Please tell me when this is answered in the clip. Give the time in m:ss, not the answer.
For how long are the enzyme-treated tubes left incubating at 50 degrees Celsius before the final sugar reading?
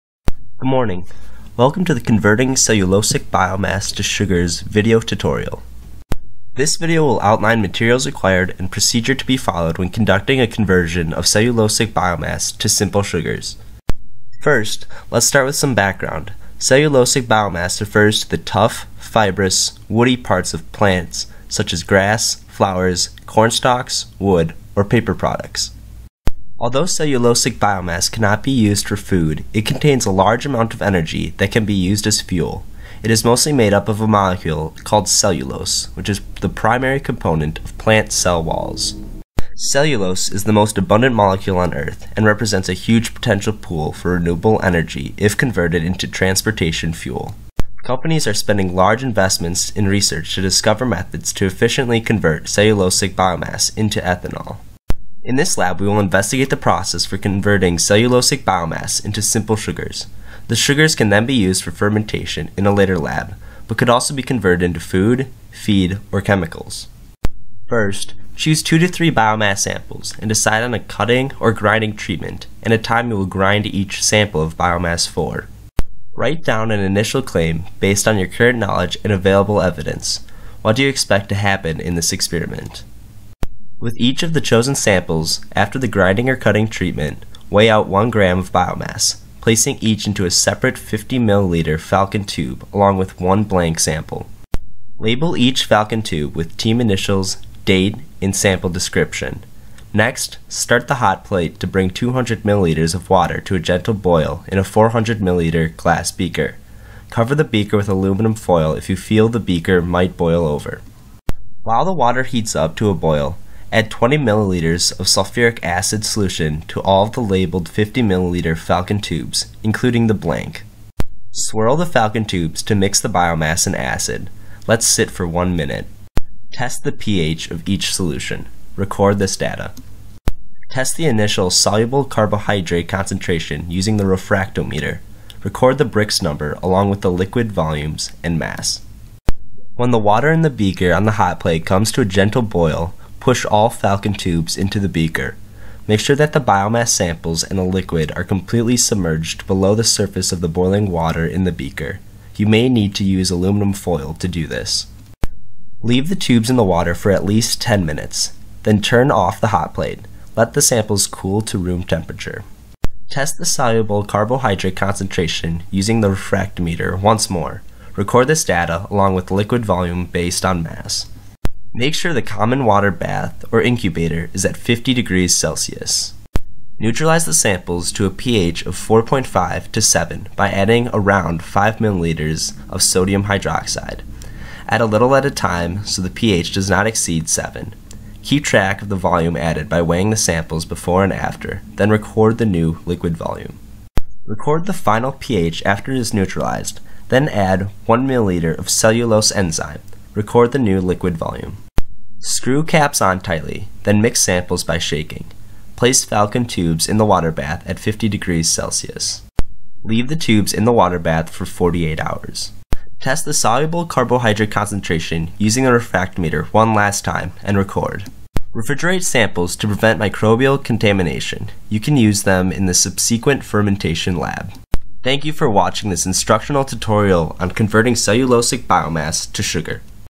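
3:31.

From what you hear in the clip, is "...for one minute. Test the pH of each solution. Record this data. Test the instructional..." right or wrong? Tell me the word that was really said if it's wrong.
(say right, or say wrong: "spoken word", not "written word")
wrong: "initial", not "instructional".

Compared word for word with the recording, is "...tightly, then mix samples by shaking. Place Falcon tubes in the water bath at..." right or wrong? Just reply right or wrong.
right.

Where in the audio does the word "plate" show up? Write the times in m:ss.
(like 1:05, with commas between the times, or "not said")
1:41, 2:21, 2:39.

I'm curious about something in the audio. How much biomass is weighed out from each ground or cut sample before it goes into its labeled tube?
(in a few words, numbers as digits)
1 gram.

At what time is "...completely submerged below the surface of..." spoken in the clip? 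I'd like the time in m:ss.
2:28.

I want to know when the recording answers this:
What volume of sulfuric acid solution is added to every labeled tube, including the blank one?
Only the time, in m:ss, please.
1:53.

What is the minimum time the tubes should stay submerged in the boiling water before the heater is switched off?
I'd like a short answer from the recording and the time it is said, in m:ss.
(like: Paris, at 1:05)
10 minutes, at 2:37.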